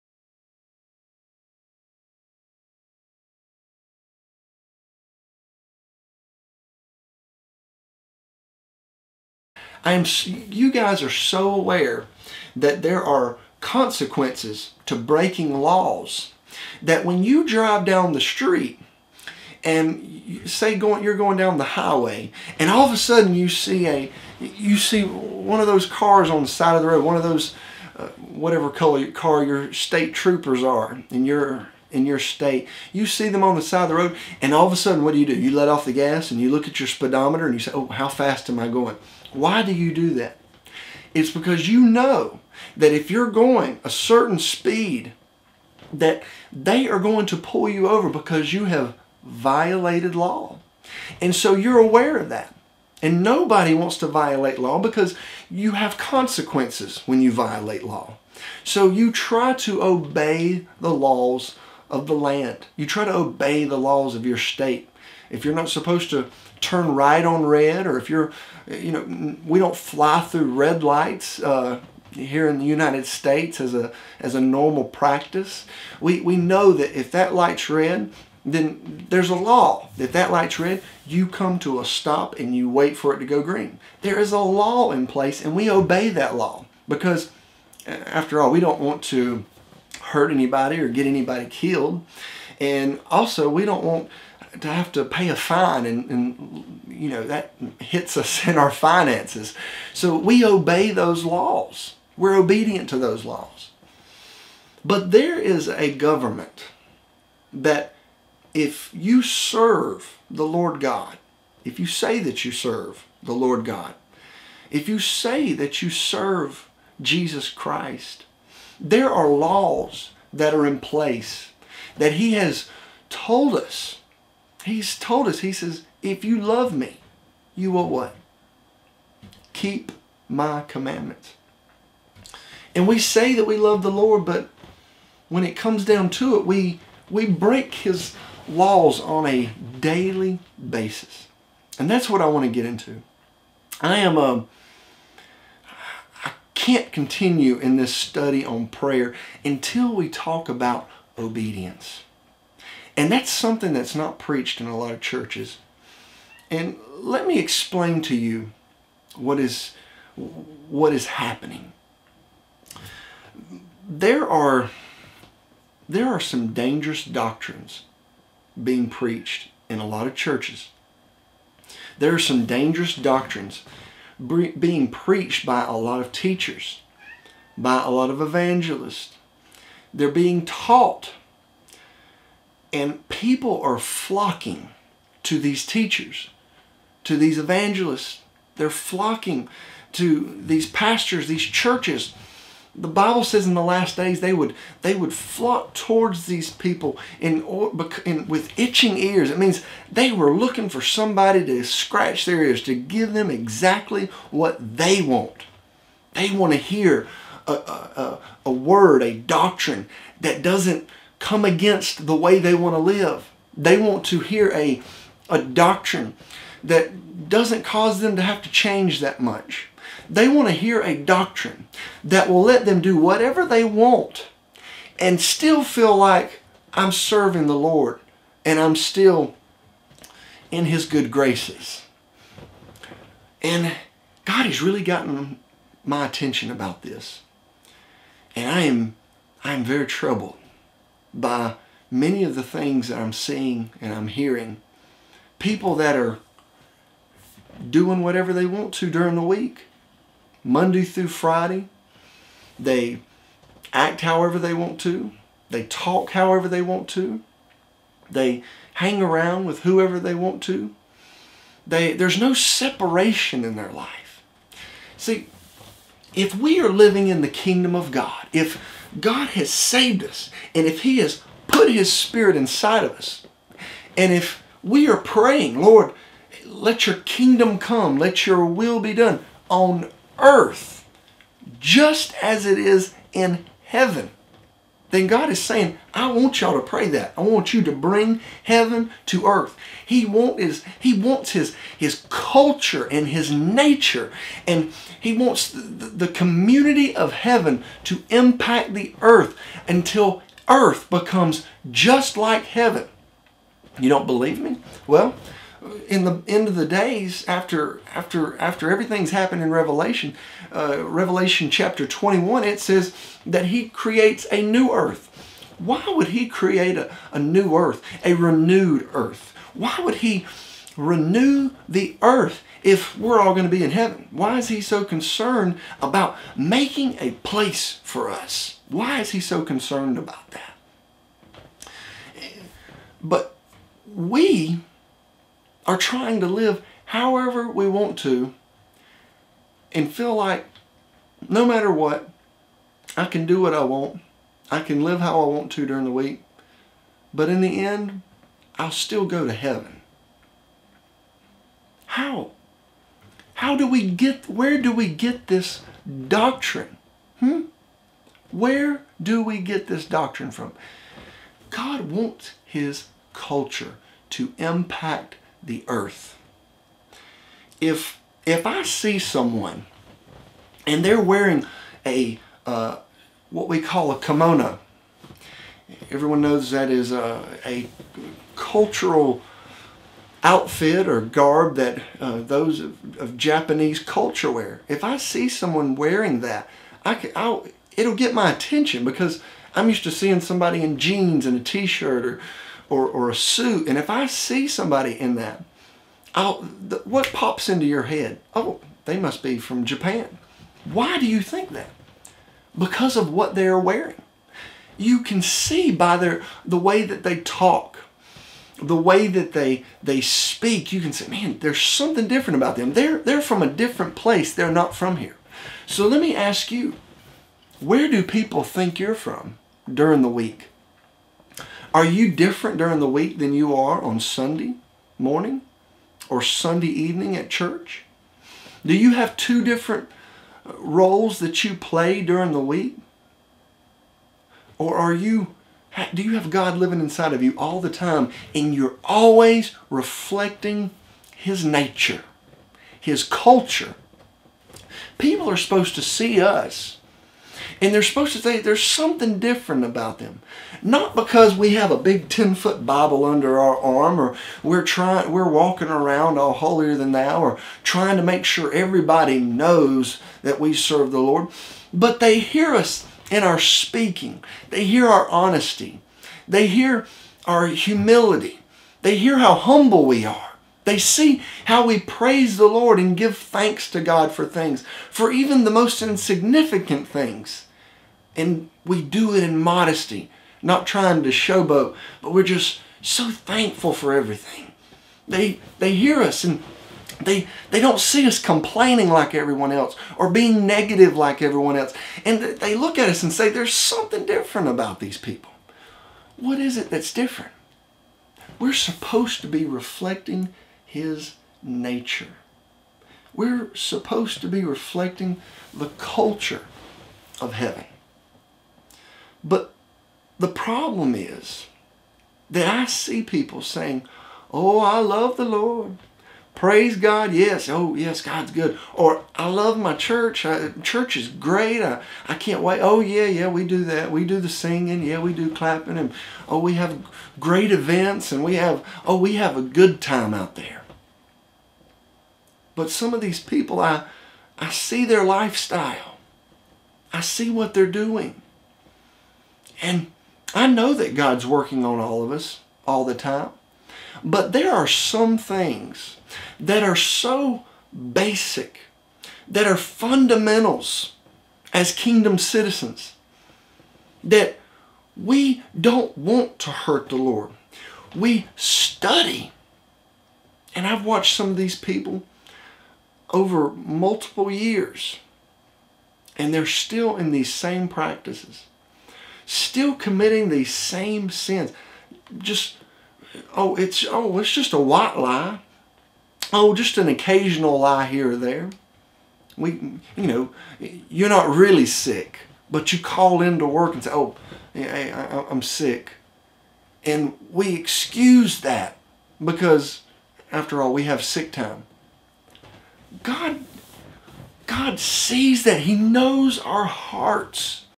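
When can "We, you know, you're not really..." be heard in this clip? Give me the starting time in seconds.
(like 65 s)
579 s.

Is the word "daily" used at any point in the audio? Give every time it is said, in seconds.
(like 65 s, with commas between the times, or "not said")
139 s.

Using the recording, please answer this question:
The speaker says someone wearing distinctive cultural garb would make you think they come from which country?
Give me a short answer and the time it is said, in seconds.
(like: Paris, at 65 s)
Japan, at 399 s.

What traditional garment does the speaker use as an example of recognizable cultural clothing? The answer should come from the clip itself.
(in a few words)
kimono.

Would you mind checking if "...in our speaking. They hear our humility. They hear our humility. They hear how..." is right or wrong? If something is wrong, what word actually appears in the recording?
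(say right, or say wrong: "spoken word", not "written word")
wrong: "honesty", not "humility".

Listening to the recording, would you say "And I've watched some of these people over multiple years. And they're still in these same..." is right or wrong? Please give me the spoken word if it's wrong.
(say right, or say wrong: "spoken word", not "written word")
right.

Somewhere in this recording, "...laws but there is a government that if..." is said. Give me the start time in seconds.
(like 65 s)
103 s.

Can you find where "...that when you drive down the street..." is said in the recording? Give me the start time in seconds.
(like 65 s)
16 s.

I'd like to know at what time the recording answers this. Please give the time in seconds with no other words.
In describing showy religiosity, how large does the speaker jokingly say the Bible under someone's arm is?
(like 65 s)
452 s.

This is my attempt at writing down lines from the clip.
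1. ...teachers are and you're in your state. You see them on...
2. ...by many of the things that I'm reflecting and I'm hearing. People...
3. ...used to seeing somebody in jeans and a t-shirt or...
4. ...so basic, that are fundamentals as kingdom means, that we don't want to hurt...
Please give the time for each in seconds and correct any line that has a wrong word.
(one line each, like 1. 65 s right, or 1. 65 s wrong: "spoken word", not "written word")
1. 30 s wrong: "troopers", not "teachers"
2. 241 s wrong: "seeing", not "reflecting"
3. 389 s right
4. 546 s wrong: "citizens", not "means".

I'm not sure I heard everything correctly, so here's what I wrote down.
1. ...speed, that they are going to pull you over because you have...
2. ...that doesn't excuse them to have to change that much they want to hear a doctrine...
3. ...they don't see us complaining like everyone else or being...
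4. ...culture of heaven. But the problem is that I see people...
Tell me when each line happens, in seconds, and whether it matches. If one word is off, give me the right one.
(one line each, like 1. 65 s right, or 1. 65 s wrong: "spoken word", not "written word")
1. 44 s right
2. 216 s wrong: "cause", not "excuse"
3. 487 s right
4. 505 s right.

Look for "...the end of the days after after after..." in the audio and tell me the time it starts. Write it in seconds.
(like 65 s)
306 s.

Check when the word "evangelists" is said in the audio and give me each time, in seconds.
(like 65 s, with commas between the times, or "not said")
178 s, 187 s.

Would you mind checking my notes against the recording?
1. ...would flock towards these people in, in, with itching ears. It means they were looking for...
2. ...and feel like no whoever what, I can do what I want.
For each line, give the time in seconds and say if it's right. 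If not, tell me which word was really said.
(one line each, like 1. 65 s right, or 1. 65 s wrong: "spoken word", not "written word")
1. 194 s right
2. 339 s wrong: "matter", not "whoever".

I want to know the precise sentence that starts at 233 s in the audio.
And God has really gotten my attention about this.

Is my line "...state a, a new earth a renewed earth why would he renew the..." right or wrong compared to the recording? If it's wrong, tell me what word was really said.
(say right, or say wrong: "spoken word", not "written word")
wrong: "create", not "state".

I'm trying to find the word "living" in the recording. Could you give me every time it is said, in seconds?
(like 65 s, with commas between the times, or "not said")
266 s, 436 s.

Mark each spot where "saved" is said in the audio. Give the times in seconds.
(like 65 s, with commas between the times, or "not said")
269 s.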